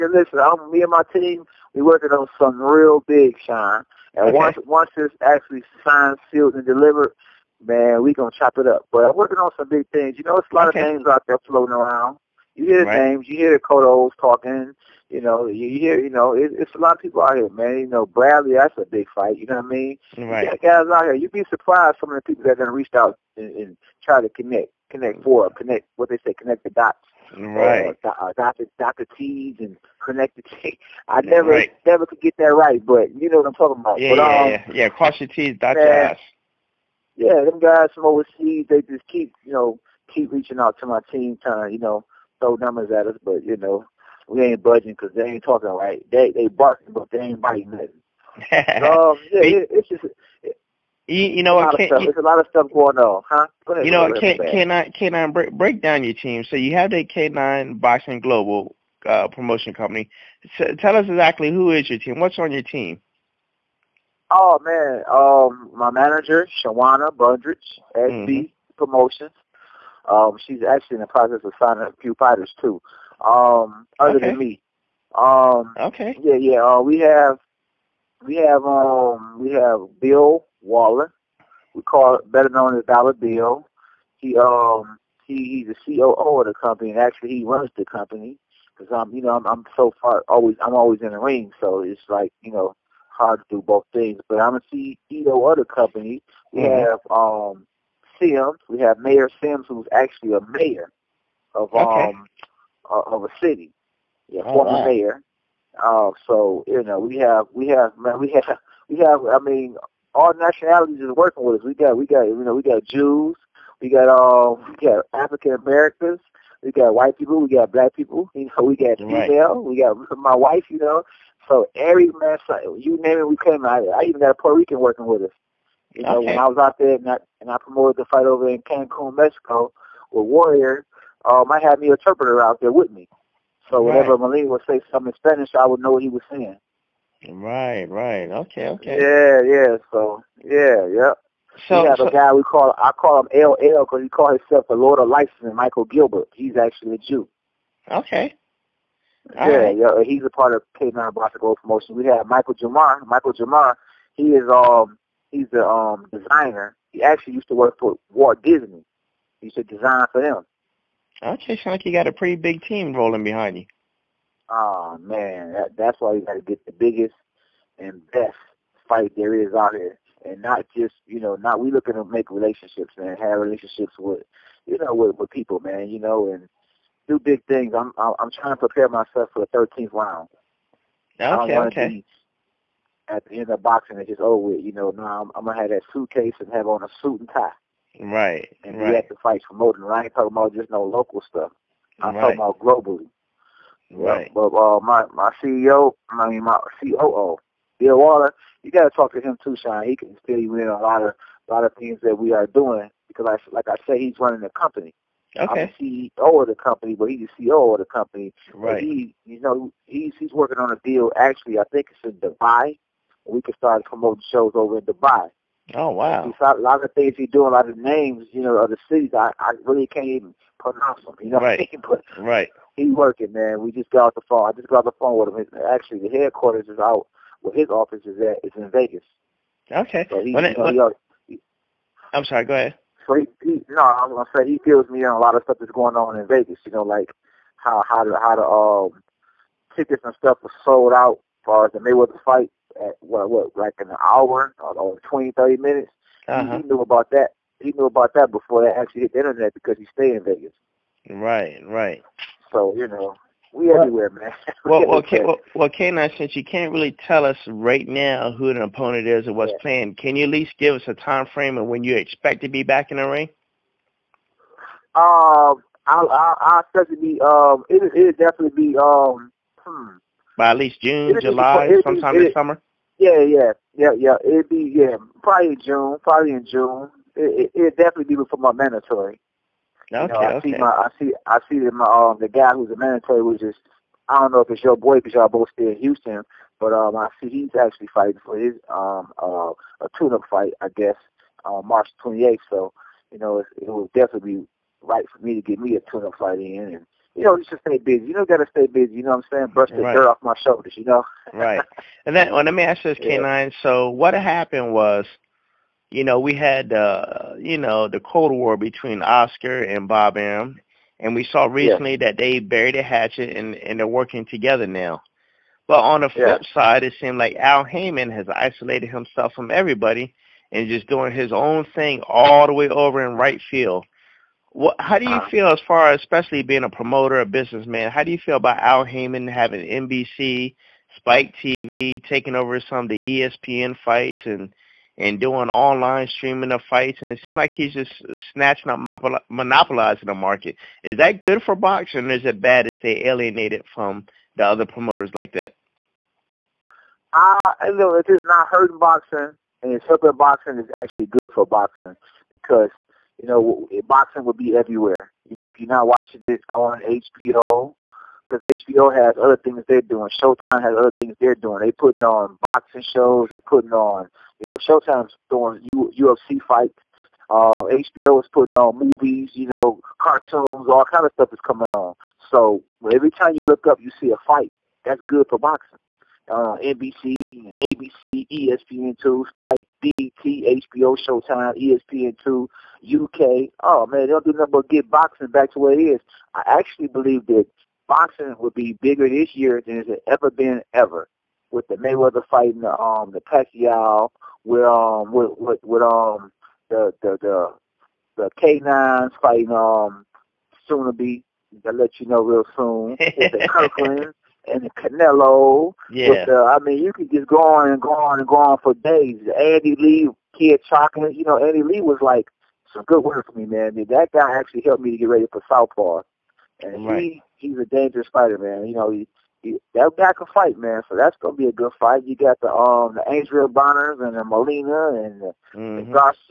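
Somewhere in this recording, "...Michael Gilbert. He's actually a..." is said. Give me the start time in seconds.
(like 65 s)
145 s.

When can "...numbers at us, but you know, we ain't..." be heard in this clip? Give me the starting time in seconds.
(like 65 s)
42 s.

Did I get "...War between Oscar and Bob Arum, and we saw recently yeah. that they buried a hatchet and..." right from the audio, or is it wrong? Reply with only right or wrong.
right.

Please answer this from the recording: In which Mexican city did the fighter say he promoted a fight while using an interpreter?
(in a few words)
Cancun.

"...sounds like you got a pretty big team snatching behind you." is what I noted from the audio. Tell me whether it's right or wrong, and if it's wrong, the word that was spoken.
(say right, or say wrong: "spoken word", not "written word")
wrong: "rolling", not "snatching".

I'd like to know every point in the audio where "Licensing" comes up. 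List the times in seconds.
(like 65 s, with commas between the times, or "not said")
145 s.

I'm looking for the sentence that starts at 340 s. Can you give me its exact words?
Is that good for boxing or is it bad to stay alienated from the other promoters like that?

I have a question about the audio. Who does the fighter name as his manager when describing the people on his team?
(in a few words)
Shawana Bundrage.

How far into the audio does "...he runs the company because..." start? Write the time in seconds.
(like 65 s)
87 s.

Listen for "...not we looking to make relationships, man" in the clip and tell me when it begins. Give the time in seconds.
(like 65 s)
171 s.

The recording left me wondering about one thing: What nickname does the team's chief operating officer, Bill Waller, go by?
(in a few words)
Dollar Bill.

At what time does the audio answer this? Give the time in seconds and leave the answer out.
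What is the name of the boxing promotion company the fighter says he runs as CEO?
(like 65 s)
57 s.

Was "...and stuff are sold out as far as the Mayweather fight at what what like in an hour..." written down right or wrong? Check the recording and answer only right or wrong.
right.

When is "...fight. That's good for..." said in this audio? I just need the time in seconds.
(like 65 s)
374 s.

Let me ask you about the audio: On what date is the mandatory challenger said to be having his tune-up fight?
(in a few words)
March 28th.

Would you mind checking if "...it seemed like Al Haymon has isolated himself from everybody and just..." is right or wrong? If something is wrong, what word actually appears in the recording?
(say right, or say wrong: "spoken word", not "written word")
right.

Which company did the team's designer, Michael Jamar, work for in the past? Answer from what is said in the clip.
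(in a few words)
Walt Disney.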